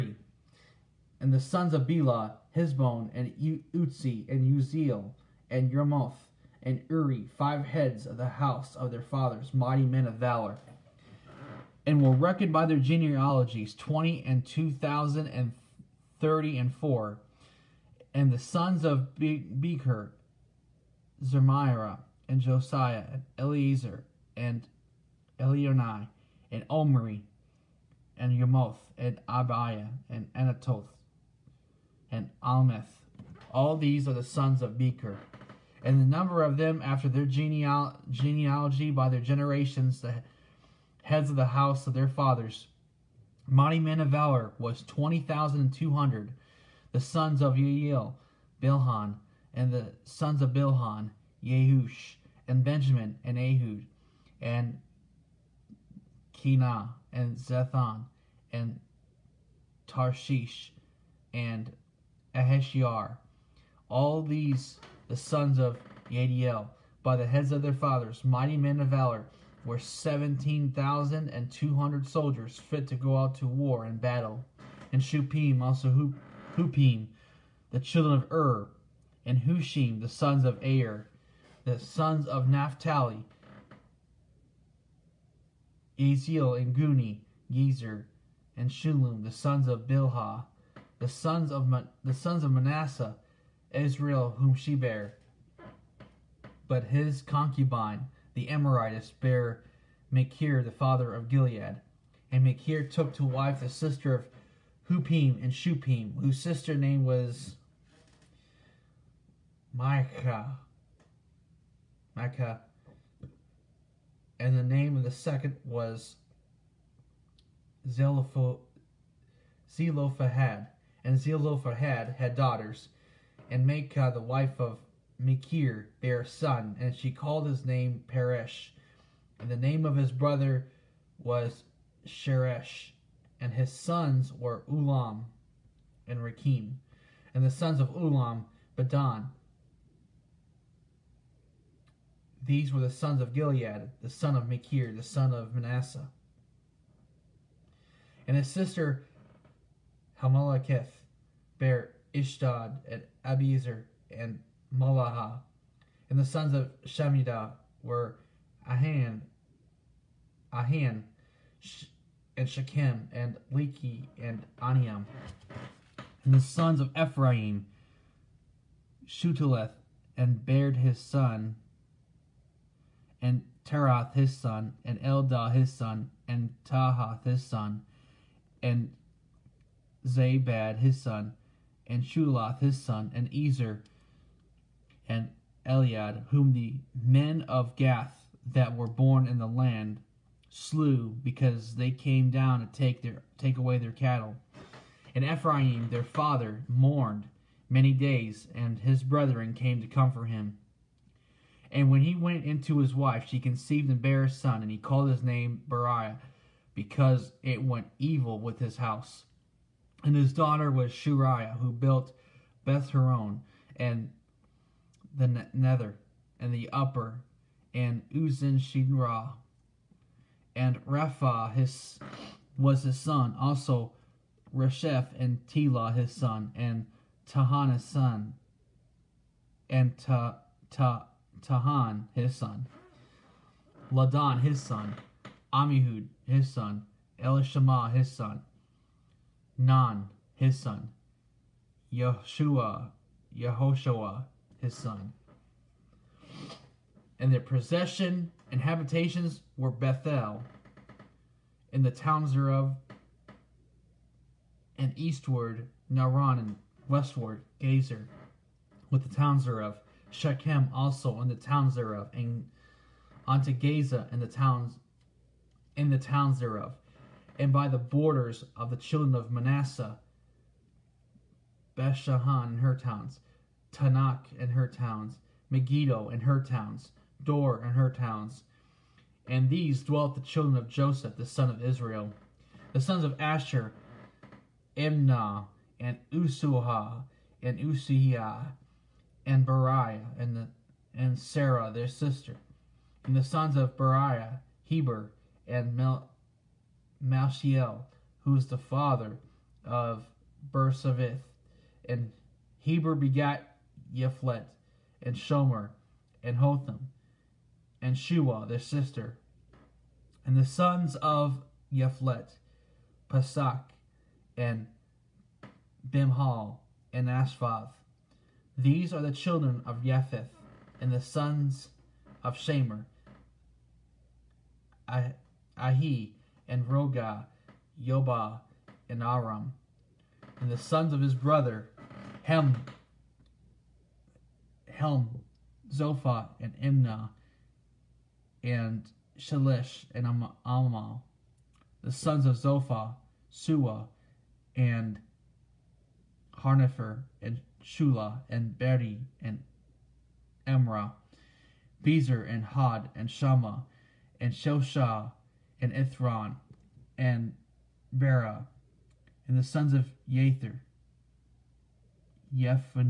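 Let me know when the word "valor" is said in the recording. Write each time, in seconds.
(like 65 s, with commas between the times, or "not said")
10 s, 44 s, 68 s.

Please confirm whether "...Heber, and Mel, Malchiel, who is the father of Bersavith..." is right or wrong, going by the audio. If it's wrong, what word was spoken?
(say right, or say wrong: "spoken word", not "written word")
right.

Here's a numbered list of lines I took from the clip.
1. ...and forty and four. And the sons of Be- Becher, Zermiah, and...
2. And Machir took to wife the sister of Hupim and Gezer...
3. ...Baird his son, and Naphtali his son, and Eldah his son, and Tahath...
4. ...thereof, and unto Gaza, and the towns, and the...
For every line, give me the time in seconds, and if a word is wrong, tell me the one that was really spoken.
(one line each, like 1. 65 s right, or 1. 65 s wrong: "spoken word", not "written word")
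1. 15 s wrong: "thirty", not "forty"
2. 102 s wrong: "Shupim", not "Gezer"
3. 170 s wrong: "Terath", not "Naphtali"
4. 261 s right.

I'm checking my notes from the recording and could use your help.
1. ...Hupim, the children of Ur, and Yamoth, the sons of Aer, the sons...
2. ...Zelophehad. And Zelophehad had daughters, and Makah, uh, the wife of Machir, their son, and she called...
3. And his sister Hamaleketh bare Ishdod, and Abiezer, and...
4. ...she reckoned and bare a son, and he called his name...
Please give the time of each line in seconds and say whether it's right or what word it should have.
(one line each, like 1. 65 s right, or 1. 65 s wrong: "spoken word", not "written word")
1. 76 s wrong: "Hushim", not "Yamoth"
2. 119 s right
3. 148 s right
4. 203 s wrong: "conceived", not "reckoned".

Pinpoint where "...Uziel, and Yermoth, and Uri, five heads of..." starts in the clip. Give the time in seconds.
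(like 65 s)
4 s.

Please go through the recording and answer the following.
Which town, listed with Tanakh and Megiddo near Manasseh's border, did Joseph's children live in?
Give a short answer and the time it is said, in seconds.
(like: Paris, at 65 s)
Dor, at 277 s.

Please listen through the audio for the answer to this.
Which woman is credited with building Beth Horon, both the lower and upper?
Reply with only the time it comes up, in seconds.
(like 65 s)
210 s.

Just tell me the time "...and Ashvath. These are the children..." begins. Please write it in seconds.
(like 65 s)
316 s.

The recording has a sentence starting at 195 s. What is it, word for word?
And Ephraim their father mourned many days, and his brethren came to comfort him.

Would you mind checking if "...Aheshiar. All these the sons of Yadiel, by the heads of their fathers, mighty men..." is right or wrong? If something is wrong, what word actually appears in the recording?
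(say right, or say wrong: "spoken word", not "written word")
right.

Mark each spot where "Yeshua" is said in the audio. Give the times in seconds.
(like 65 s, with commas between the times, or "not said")
241 s.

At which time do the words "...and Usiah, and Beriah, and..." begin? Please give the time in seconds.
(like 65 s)
287 s.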